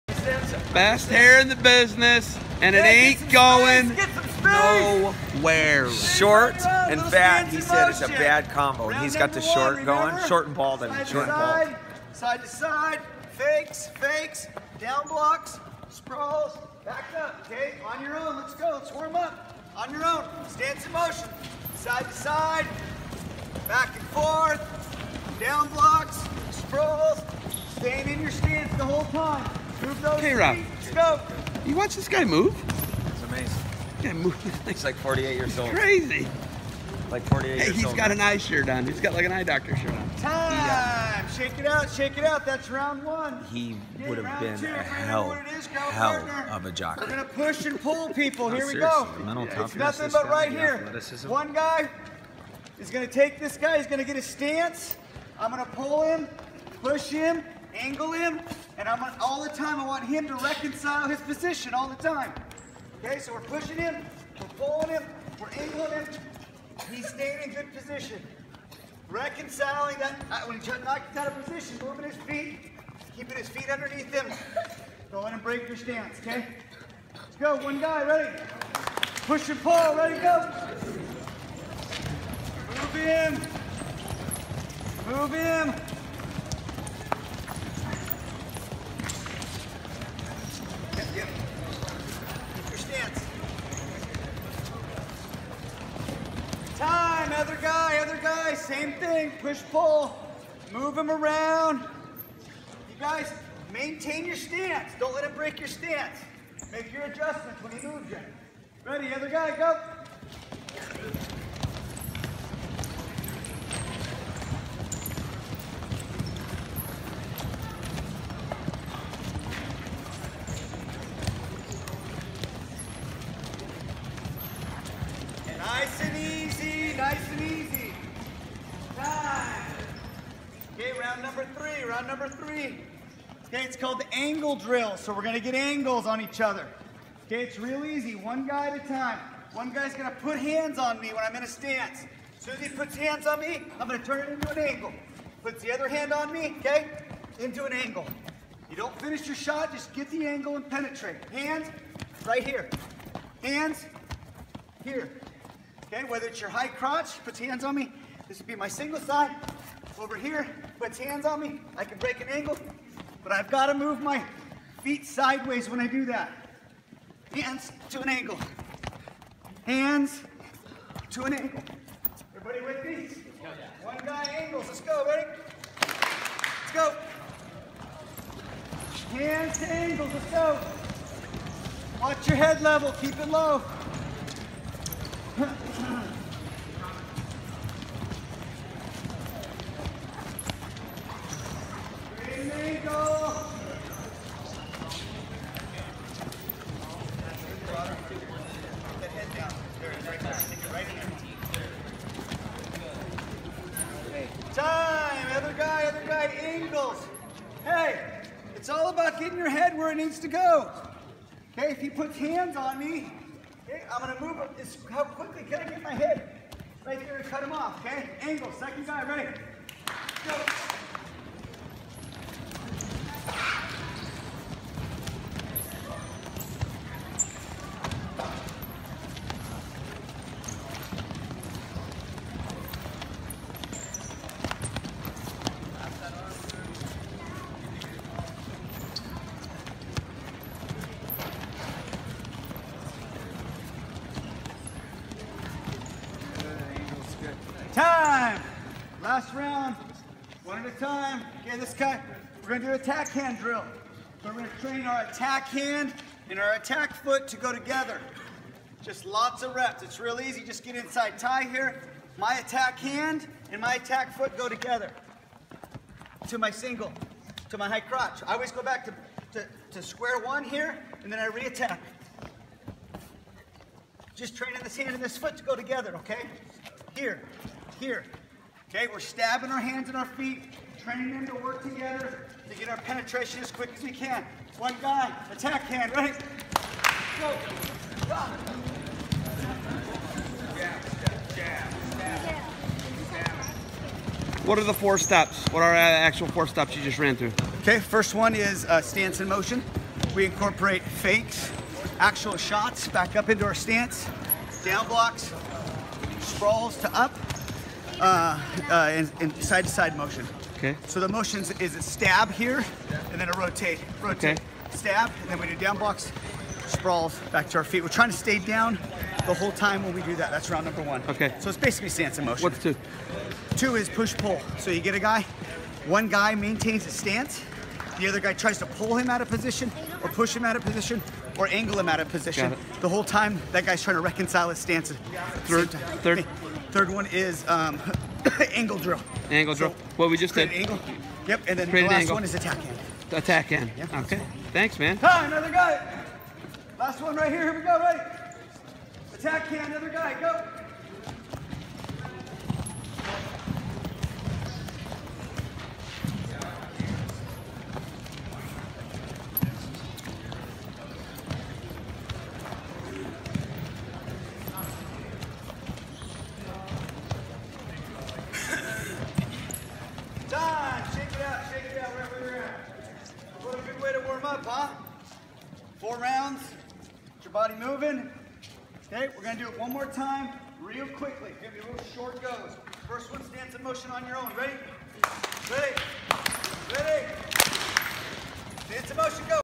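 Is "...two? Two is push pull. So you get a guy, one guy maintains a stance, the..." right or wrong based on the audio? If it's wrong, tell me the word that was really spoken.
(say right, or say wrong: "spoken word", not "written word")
right.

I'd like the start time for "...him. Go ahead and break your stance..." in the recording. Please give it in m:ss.
1:14.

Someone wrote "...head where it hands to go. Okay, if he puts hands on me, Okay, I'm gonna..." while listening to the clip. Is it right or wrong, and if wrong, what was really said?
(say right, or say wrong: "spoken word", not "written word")
wrong: "needs", not "hands".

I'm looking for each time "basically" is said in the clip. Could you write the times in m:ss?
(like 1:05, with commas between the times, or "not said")
5:21.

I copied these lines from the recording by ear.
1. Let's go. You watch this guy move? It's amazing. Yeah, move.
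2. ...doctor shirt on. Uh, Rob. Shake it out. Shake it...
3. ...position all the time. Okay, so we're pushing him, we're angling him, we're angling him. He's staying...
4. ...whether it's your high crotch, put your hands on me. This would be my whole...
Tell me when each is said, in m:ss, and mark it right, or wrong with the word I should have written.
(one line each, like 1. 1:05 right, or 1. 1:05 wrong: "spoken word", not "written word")
1. 0:30 right
2. 0:39 wrong: "Time", not "Rob"
3. 1:01 wrong: "pulling", not "angling"
4. 2:36 wrong: "single", not "whole".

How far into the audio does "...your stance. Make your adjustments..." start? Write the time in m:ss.
1:45.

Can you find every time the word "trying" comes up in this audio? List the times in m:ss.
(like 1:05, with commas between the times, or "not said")
5:17, 5:33.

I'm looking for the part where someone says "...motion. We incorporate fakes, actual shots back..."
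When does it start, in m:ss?
4:59.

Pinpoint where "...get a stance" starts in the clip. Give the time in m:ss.
0:54.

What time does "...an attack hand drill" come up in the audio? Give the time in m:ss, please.
4:12.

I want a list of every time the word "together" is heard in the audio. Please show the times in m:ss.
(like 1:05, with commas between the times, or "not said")
4:17, 4:24, 4:35, 4:41.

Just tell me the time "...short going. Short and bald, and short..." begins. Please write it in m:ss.
0:09.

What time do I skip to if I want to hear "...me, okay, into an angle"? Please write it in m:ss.
2:26.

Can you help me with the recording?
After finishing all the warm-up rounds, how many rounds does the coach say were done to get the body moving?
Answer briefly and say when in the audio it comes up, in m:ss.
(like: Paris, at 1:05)
4, at 6:15.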